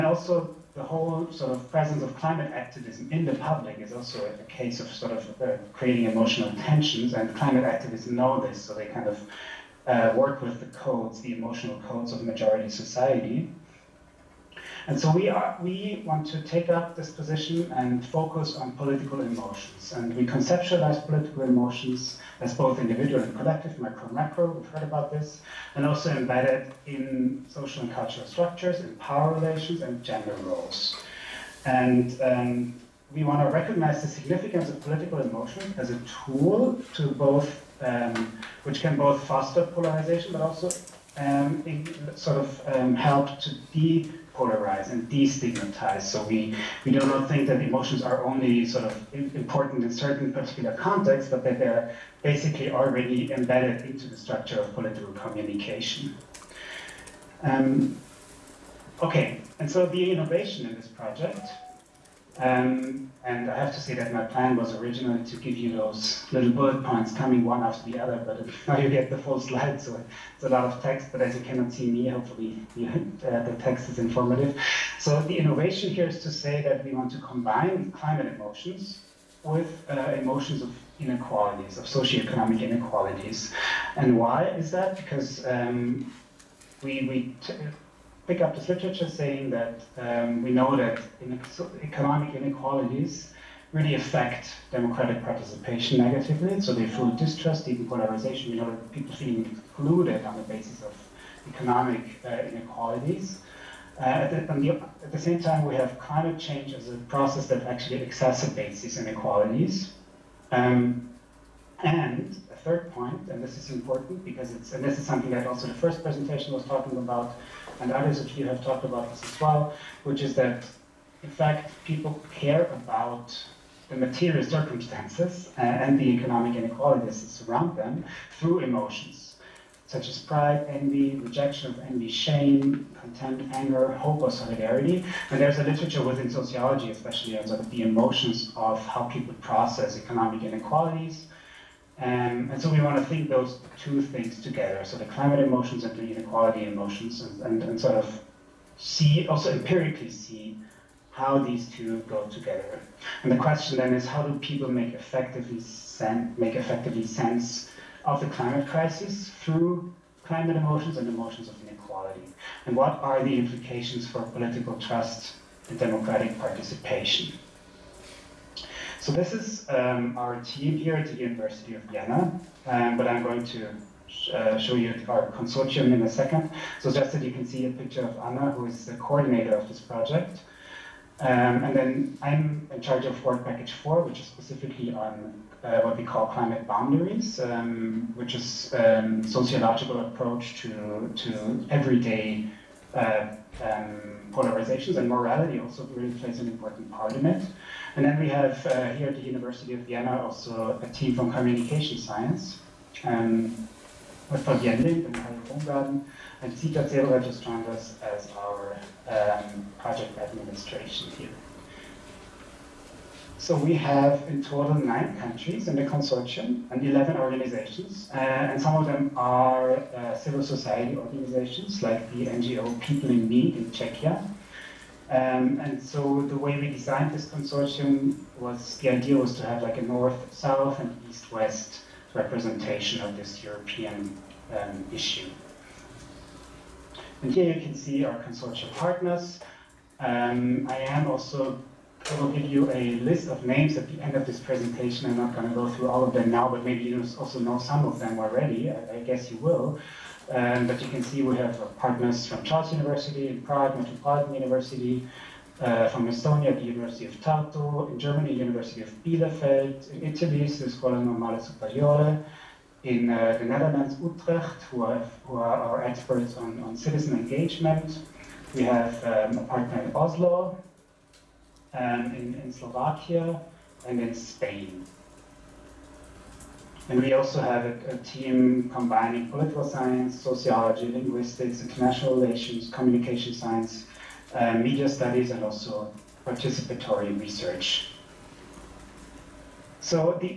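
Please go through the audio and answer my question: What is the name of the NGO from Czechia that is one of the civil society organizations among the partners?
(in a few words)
People in Need.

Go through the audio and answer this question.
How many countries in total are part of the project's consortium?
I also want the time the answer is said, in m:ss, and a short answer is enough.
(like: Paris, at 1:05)
9, at 3:34.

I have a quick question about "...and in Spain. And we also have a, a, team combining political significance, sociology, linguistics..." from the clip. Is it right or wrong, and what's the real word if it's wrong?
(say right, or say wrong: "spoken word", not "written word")
wrong: "science", not "significance".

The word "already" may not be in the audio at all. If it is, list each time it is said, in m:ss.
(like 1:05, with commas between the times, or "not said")
0:52, 4:08.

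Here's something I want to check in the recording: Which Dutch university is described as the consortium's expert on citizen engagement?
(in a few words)
Utrecht.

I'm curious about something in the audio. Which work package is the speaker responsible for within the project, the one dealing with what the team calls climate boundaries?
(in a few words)
Work package 4.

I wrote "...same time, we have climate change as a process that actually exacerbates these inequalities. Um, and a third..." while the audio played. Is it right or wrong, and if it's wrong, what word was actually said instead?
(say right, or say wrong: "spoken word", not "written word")
right.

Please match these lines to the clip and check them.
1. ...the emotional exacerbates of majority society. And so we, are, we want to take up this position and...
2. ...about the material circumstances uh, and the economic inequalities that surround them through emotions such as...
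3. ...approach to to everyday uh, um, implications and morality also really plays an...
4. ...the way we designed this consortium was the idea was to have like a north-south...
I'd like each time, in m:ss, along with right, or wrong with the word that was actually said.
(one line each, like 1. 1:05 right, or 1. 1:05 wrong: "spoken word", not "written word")
1. 0:11 wrong: "codes", not "exacerbates"
2. 2:02 right
3. 3:09 wrong: "polarizations", not "implications"
4. 3:46 right.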